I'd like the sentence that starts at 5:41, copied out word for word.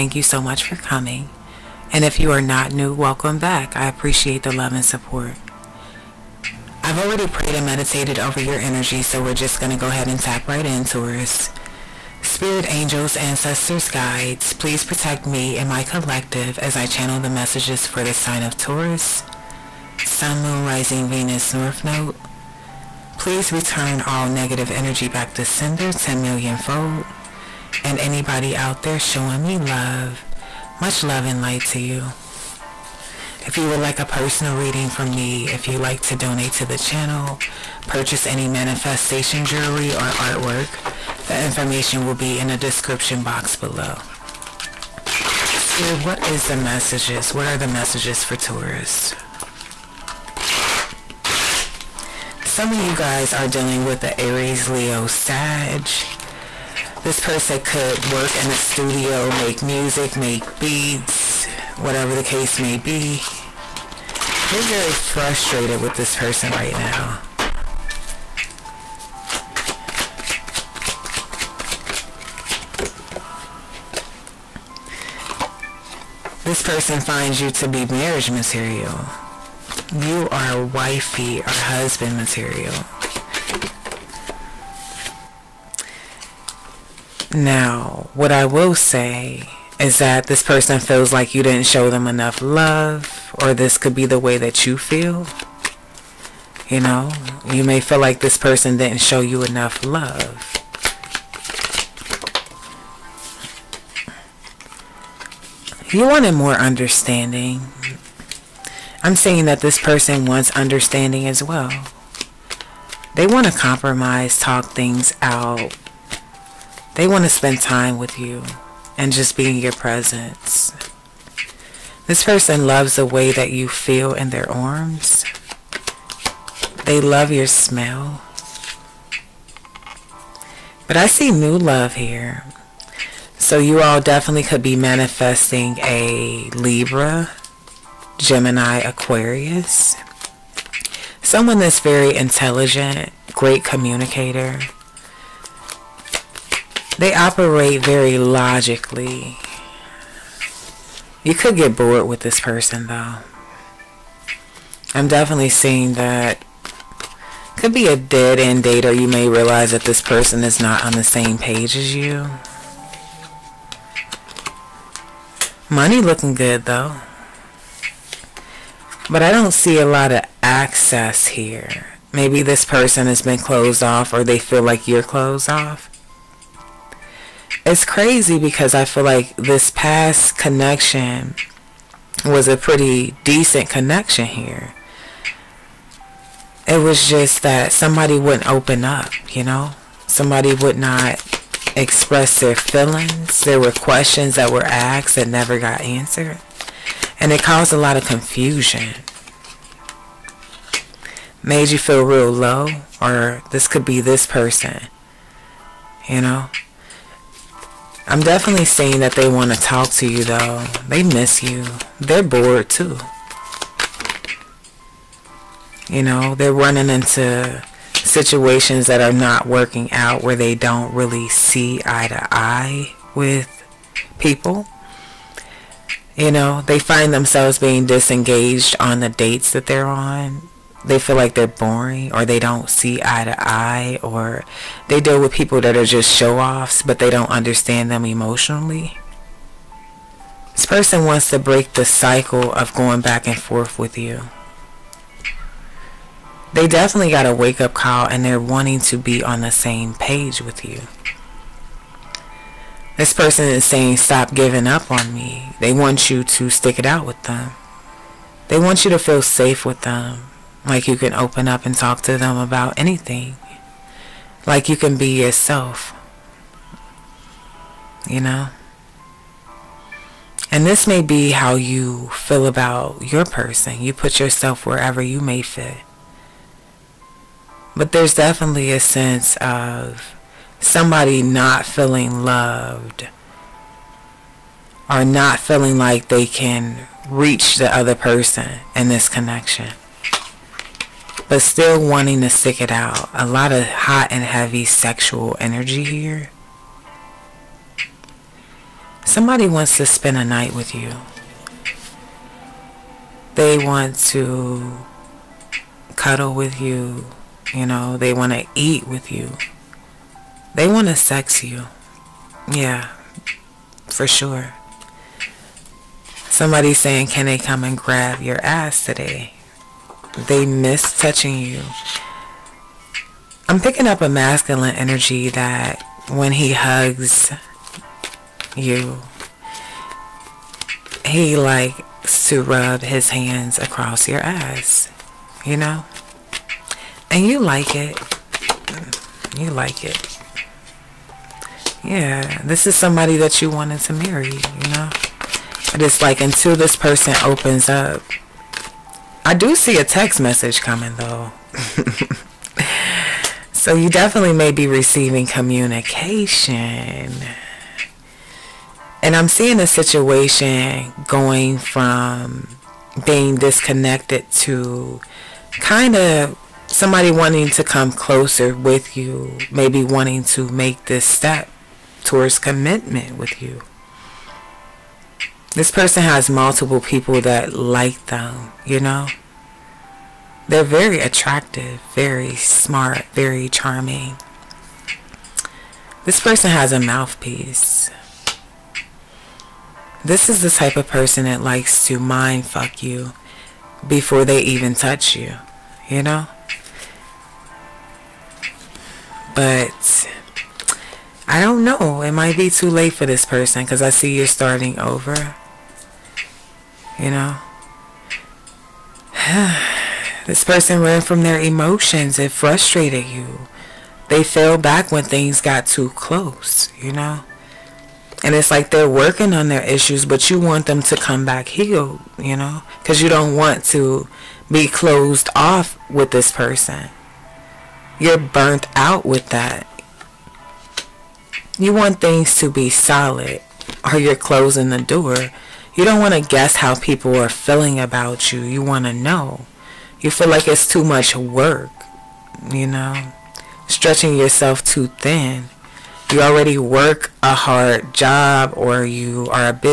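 Yeah, this is somebody that you wanted to marry, you know?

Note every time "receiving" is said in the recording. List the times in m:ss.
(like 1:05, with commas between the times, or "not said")
5:54.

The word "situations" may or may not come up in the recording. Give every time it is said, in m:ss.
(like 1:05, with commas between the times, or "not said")
3:37, 5:59.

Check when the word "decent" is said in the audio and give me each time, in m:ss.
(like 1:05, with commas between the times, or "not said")
3:03.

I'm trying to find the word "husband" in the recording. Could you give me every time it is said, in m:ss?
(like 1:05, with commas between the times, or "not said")
1:21.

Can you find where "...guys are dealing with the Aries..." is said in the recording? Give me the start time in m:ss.
0:52.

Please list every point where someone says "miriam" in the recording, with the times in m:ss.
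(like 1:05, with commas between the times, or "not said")
not said.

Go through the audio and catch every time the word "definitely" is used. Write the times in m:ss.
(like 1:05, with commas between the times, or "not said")
2:14, 2:35, 3:28, 4:06, 4:38, 5:53.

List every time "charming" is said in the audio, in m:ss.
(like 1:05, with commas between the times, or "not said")
6:23.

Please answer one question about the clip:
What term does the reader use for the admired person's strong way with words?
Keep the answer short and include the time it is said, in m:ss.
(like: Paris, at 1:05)
A mouthpiece, at 6:26.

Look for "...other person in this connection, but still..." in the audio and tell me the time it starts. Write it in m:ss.
4:47.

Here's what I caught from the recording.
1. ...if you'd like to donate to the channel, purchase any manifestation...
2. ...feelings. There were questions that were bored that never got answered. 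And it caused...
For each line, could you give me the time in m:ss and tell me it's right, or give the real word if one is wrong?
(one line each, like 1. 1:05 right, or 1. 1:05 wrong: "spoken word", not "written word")
1. 0:35 right
2. 3:12 wrong: "asked", not "bored".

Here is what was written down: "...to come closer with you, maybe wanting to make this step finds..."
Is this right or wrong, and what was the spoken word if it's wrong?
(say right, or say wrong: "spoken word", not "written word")
wrong: "towards", not "finds".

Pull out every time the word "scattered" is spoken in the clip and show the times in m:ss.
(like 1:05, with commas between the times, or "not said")
not said.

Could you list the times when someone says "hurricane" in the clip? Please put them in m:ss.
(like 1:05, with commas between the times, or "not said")
not said.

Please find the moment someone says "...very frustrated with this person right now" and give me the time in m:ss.
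1:04.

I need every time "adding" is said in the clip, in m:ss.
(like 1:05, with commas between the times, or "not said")
not said.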